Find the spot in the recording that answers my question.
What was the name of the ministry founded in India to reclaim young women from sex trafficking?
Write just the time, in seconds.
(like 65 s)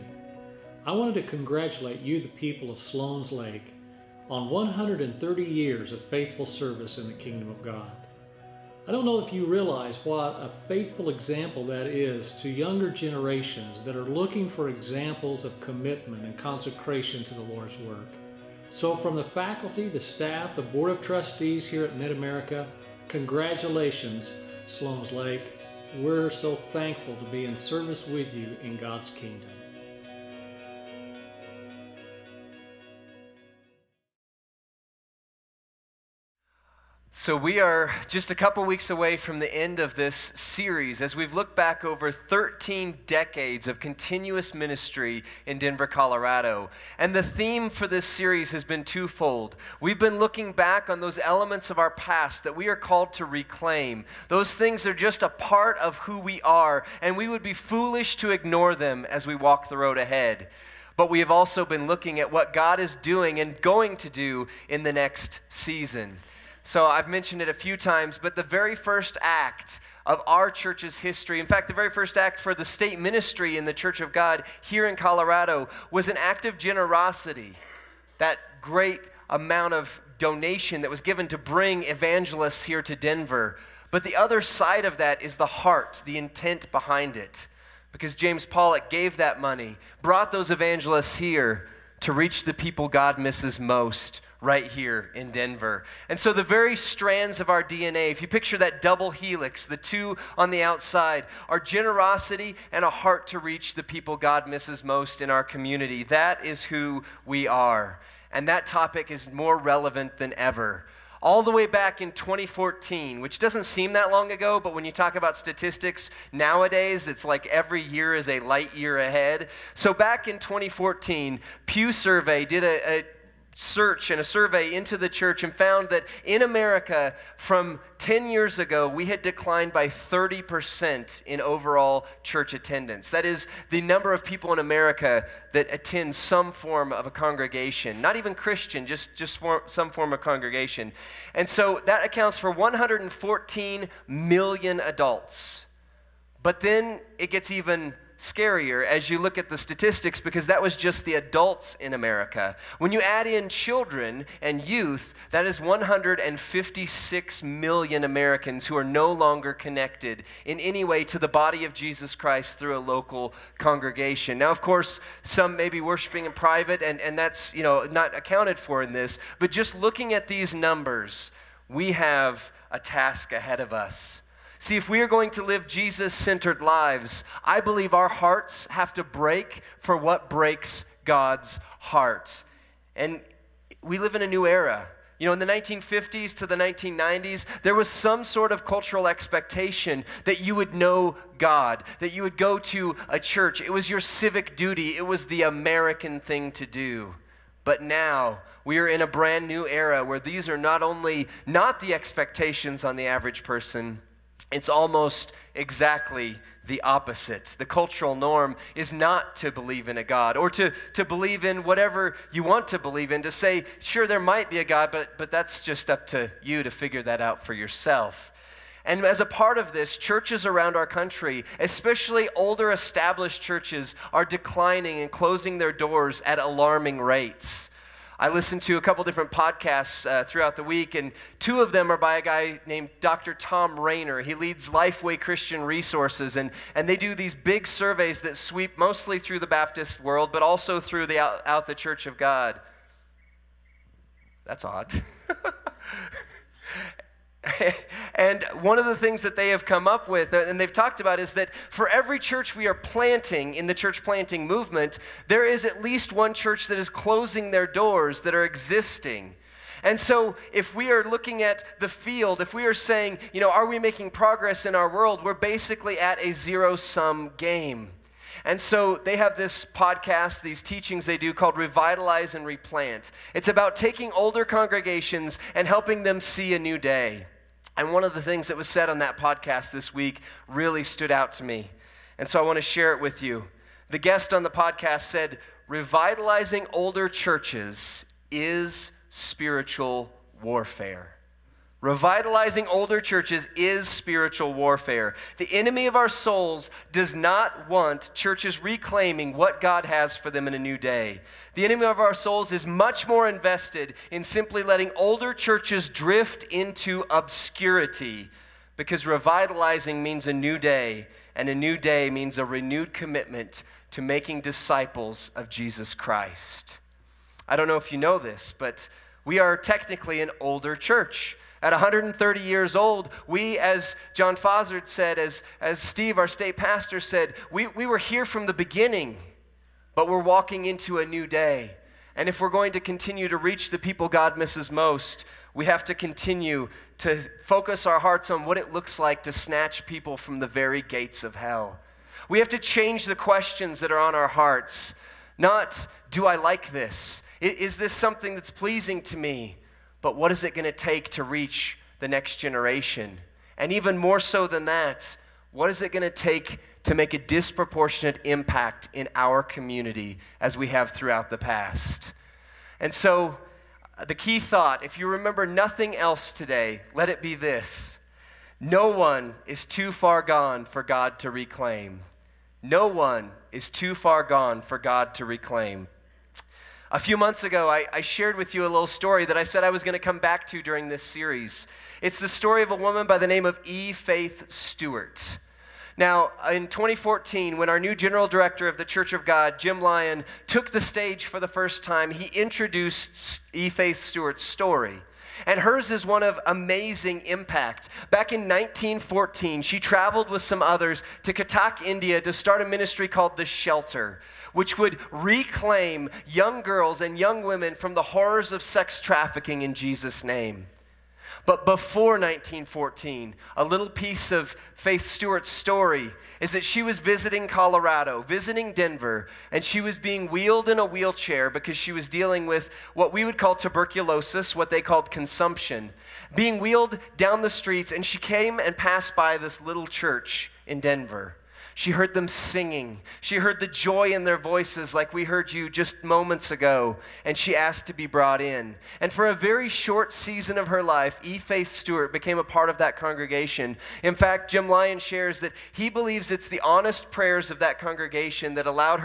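403 s.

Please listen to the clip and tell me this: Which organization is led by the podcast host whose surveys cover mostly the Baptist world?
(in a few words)
Lifeway Christian Resources.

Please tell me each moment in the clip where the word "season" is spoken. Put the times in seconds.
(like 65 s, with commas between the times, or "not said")
65 s, 440 s.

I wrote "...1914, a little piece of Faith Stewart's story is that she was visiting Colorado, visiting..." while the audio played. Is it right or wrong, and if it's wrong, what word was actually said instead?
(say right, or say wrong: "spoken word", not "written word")
right.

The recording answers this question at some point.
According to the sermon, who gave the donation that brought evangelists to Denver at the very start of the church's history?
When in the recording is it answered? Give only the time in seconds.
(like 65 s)
88 s.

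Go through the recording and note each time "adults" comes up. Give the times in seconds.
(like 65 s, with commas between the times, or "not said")
144 s, 151 s.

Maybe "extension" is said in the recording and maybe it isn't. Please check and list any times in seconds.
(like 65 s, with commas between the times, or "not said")
not said.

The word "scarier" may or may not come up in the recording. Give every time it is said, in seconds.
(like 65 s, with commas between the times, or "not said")
148 s.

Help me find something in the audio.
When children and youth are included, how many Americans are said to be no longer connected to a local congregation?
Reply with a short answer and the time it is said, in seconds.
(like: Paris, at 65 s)
156 million, at 155 s.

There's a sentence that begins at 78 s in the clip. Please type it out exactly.
That great amount of donation that was given to bring evangelists here to Denver.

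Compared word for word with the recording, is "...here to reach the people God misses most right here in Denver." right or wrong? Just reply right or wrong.
right.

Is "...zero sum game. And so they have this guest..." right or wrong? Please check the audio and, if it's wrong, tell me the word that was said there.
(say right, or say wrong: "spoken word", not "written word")
wrong: "podcast", not "guest".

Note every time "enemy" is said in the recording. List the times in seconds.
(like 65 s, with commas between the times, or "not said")
295 s, 301 s.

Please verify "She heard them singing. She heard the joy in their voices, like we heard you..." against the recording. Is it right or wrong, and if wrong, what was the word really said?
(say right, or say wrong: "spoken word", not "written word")
right.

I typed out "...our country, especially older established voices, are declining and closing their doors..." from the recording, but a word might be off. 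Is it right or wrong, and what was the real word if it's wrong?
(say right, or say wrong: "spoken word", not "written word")
wrong: "churches", not "voices".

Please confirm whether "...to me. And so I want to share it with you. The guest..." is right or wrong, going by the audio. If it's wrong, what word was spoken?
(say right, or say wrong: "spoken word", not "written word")
right.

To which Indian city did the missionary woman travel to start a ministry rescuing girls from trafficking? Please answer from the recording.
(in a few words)
Cuttack.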